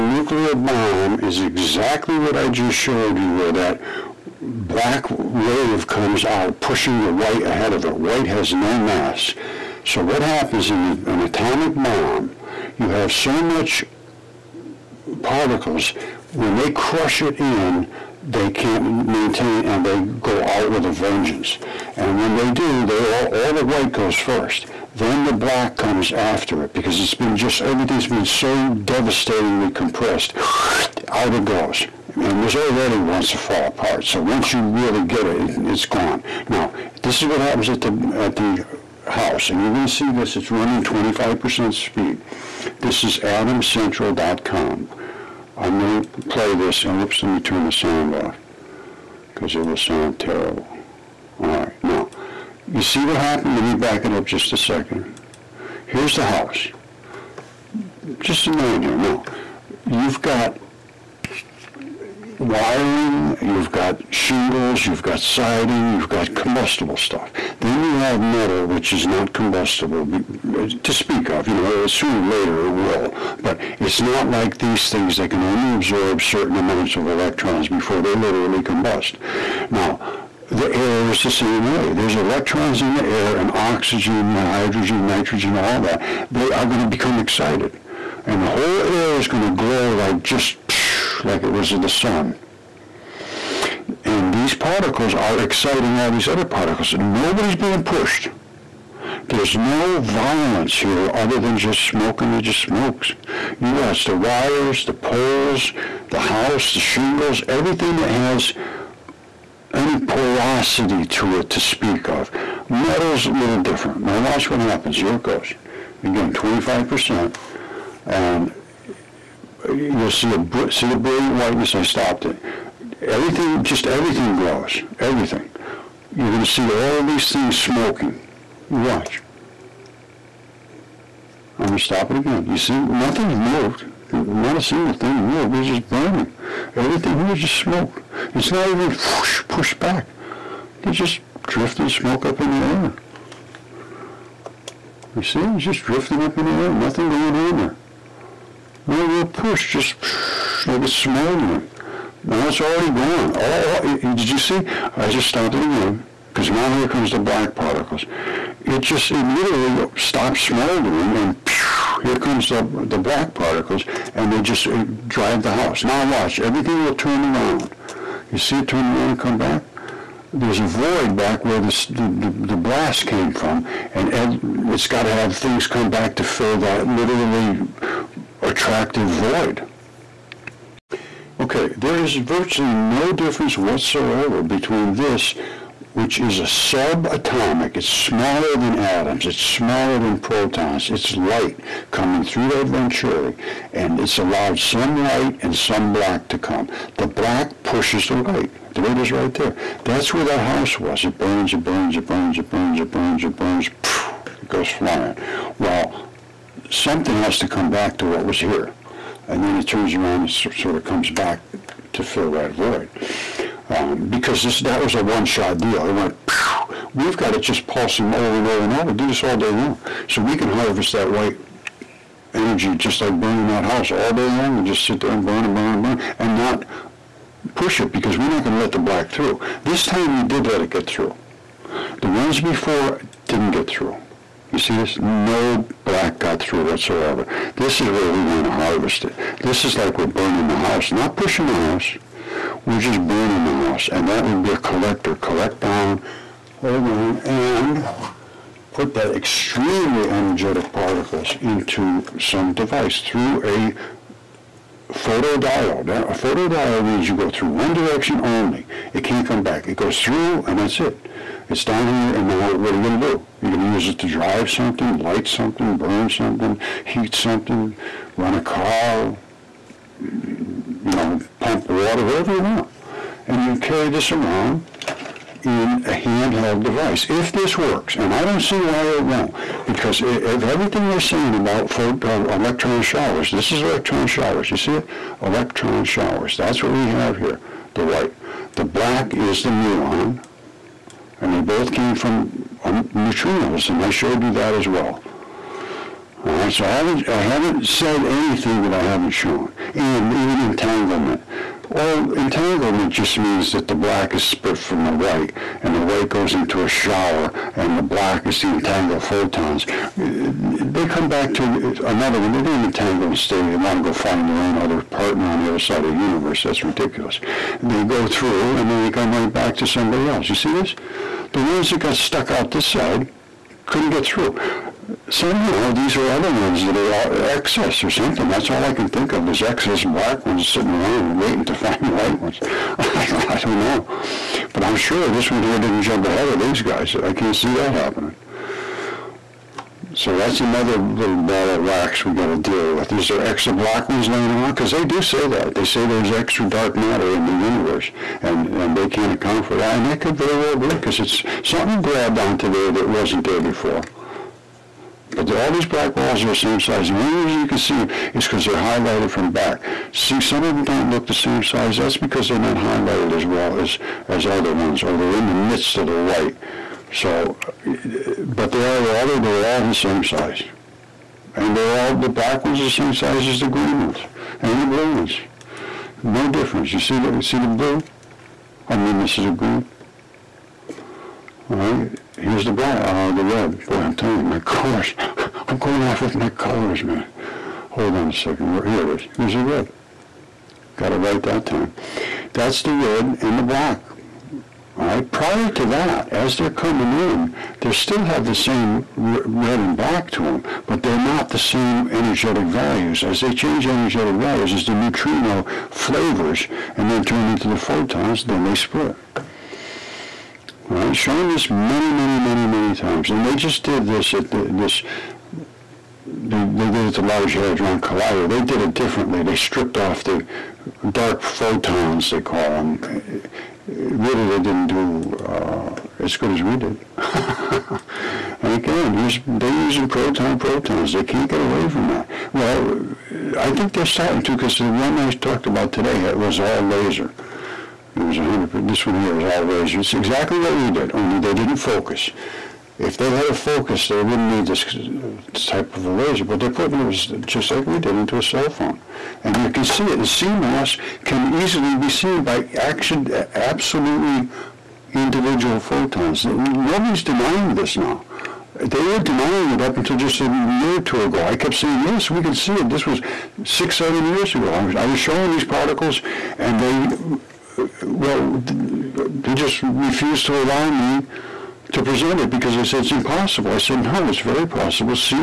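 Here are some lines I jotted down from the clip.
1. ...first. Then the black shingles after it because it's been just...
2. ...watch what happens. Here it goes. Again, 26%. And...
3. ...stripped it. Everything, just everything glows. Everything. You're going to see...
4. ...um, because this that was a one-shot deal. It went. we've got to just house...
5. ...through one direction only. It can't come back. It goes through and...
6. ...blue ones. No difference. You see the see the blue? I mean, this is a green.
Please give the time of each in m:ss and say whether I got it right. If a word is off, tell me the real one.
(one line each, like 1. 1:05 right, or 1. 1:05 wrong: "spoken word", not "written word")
1. 0:24 wrong: "comes", not "shingles"
2. 1:54 wrong: "25", not "26"
3. 2:01 wrong: "stopped", not "stripped"
4. 3:33 wrong: "pulse", not "house"
5. 4:17 right
6. 6:14 right.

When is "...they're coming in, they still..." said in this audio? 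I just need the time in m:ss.
6:36.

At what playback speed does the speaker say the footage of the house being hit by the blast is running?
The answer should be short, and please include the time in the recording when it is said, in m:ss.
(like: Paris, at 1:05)
25%, at 0:40.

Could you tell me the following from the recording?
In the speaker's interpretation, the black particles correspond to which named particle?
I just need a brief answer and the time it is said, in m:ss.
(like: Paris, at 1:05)
muon, at 4:49.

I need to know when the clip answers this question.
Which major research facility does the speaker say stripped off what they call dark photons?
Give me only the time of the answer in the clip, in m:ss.
6:57.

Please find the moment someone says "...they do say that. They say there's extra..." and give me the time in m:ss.
5:44.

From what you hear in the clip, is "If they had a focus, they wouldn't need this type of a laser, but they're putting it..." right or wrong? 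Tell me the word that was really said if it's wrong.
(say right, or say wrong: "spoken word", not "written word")
right.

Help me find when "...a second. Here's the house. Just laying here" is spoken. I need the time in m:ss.
0:54.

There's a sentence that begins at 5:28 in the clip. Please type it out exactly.
That's all I can think of.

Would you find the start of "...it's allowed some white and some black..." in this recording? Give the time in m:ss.
3:13.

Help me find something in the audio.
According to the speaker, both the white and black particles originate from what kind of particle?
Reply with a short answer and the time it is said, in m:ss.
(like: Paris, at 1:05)
neutrinos, at 4:52.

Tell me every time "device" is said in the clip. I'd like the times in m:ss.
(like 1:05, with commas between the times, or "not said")
4:12, 4:36.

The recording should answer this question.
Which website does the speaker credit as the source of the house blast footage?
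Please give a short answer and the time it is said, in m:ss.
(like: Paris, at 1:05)
atomcentral.com, at 0:43.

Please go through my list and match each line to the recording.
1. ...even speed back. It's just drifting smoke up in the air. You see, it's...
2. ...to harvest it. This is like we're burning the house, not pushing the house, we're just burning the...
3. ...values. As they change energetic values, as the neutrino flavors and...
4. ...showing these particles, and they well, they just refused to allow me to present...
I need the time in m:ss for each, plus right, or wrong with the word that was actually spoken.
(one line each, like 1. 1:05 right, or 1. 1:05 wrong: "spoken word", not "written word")
1. 2:18 wrong: "pushed", not "speed"
2. 3:58 right
3. 6:42 right
4. 7:44 right.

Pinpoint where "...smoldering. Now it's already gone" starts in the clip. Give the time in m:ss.
2:30.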